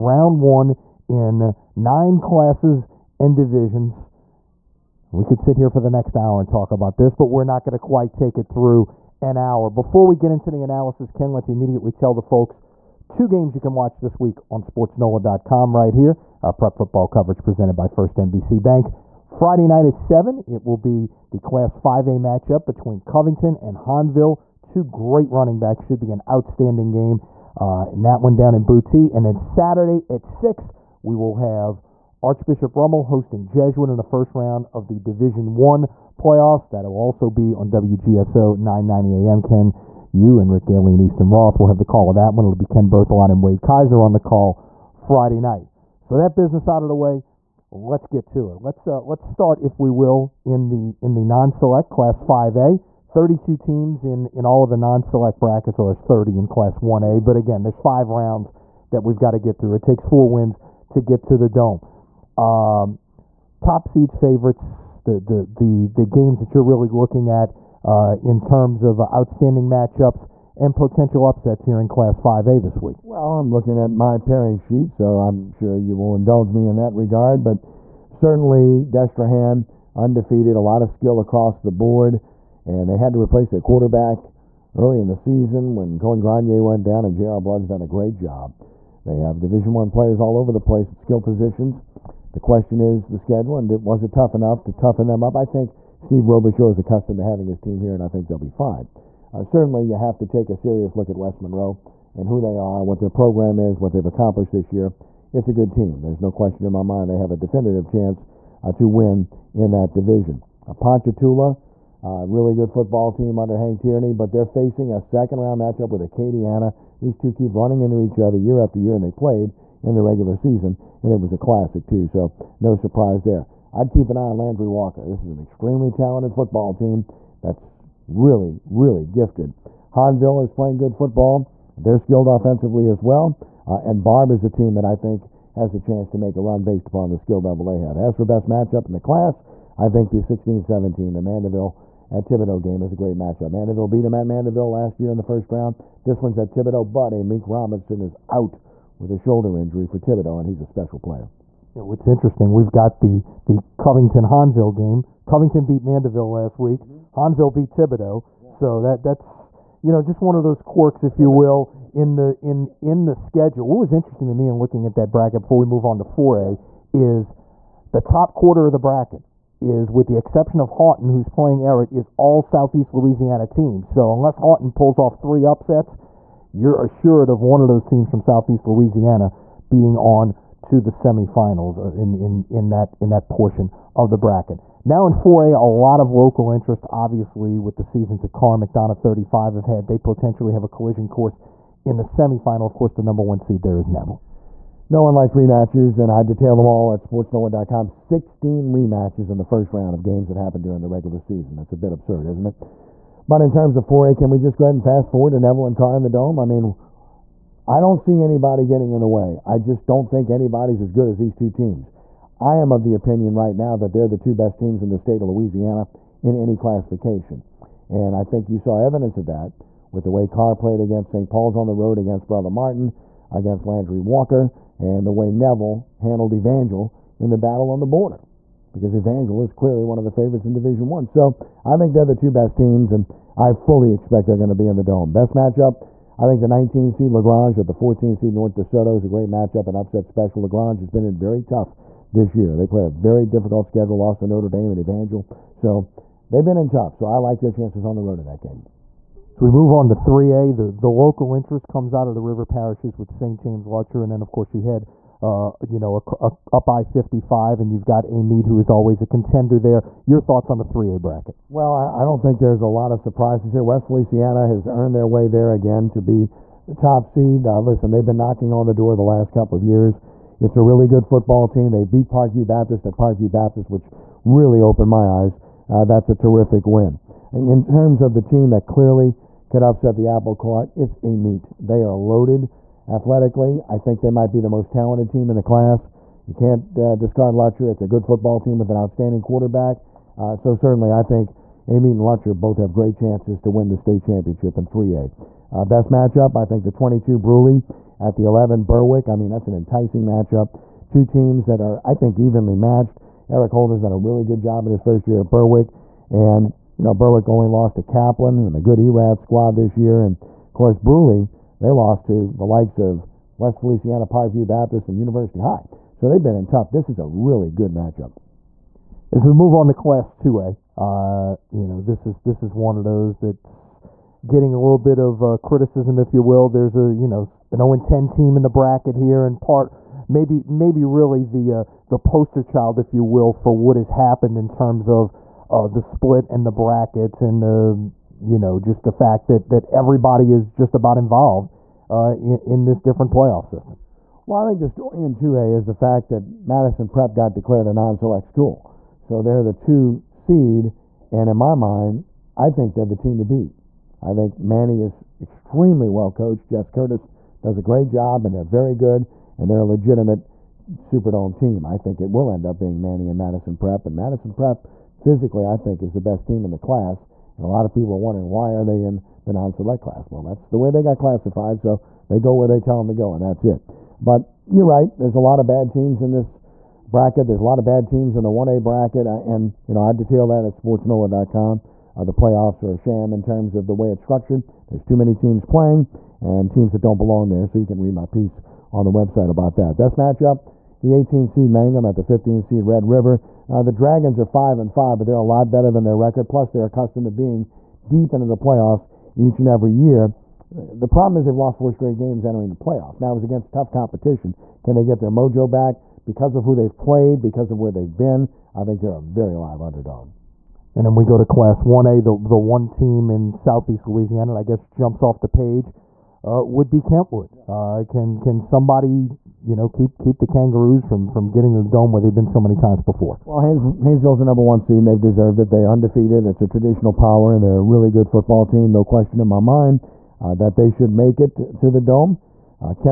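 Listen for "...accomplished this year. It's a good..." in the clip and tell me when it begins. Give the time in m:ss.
1:44.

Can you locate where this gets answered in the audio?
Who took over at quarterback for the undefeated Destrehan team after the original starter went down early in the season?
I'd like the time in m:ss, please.
1:27.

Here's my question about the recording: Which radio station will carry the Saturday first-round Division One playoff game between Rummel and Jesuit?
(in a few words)
WGSO 990 AM.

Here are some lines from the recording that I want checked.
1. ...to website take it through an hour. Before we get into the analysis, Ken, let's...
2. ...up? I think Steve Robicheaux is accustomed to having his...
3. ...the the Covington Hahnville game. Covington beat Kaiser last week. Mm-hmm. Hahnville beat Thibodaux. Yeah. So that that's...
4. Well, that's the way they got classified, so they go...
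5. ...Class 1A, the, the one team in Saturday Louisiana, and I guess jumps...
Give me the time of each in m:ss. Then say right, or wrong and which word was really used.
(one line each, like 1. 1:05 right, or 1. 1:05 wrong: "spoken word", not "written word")
1. 0:07 wrong: "quite", not "website"
2. 1:35 right
3. 2:33 wrong: "Mandeville", not "Kaiser"
4. 6:10 right
5. 6:51 wrong: "Southeast", not "Saturday".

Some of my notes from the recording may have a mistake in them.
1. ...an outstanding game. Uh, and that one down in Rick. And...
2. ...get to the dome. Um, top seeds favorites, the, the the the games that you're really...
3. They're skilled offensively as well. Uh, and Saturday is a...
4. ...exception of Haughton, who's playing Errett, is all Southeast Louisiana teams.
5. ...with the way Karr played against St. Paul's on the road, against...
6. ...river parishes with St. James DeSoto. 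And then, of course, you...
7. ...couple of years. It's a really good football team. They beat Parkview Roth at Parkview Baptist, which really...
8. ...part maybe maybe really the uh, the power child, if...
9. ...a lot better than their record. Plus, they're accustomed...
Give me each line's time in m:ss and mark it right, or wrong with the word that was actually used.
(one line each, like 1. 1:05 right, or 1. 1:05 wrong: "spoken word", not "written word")
1. 0:26 wrong: "Boutte", not "Rick"
2. 1:01 right
3. 2:11 wrong: "Barbe", not "Saturday"
4. 2:50 right
5. 3:39 right
6. 4:12 wrong: "Lutcher", not "DeSoto"
7. 4:29 wrong: "Baptist", not "Roth"
8. 5:29 wrong: "poster", not "power"
9. 6:35 right.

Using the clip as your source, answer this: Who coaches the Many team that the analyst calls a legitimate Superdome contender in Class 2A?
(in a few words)
Jess Curtis.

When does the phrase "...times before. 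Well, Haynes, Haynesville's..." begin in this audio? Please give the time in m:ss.
7:02.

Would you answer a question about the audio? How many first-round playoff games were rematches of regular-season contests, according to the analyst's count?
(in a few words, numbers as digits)
16.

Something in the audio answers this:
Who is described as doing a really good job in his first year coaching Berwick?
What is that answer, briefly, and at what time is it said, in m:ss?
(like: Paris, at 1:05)
Eric Holden, at 5:03.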